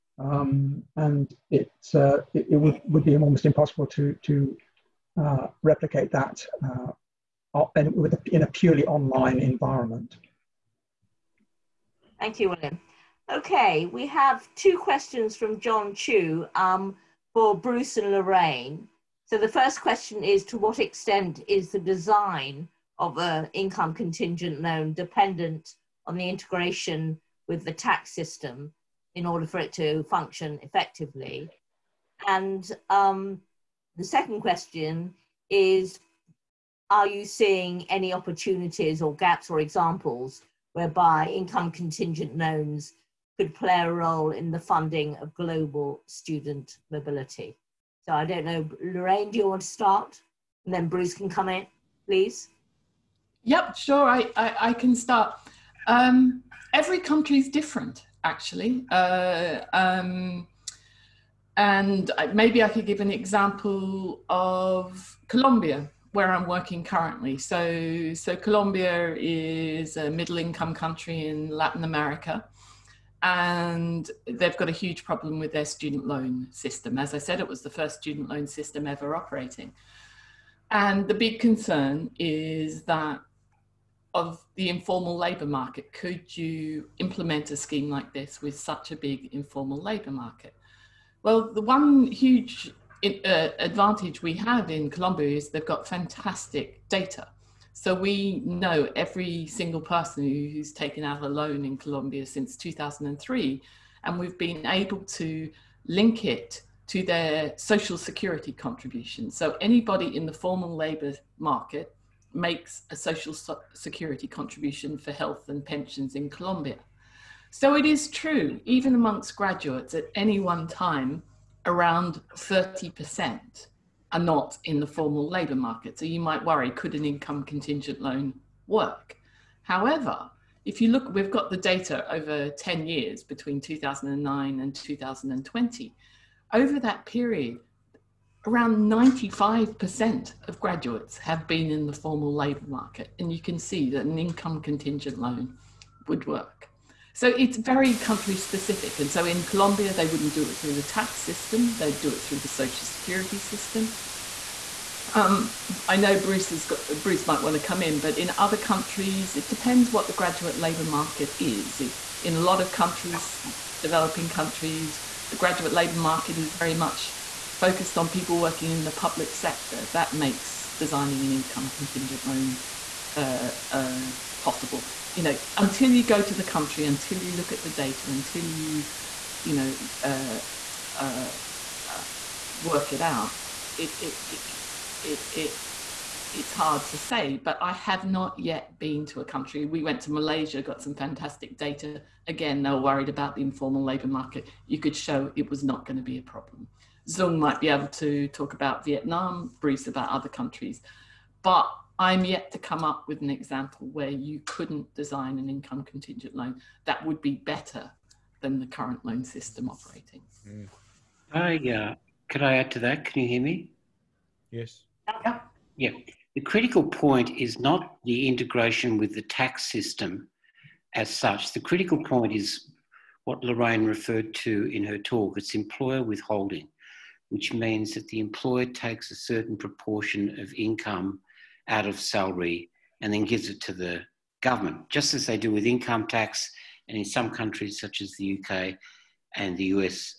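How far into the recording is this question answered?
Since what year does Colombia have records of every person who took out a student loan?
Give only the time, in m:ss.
1:42.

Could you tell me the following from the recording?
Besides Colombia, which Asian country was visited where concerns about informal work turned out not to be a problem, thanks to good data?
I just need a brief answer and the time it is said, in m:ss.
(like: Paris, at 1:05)
Malaysia, at 3:10.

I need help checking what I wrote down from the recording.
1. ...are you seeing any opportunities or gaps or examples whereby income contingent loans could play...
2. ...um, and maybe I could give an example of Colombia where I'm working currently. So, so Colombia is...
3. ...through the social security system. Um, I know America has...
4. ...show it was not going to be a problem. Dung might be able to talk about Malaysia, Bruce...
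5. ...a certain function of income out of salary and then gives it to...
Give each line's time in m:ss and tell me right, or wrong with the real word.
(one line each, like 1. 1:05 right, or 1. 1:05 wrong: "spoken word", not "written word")
1. 0:36 right
2. 0:59 right
3. 2:32 wrong: "Bruce", not "America"
4. 3:14 wrong: "Vietnam", not "Malaysia"
5. 3:49 wrong: "proportion", not "function".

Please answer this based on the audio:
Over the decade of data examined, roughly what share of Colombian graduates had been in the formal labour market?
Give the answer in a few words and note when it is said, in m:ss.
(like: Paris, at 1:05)
95%, at 2:18.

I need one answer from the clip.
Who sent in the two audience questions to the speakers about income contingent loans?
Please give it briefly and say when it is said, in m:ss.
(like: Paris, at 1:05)
John Chu, at 0:15.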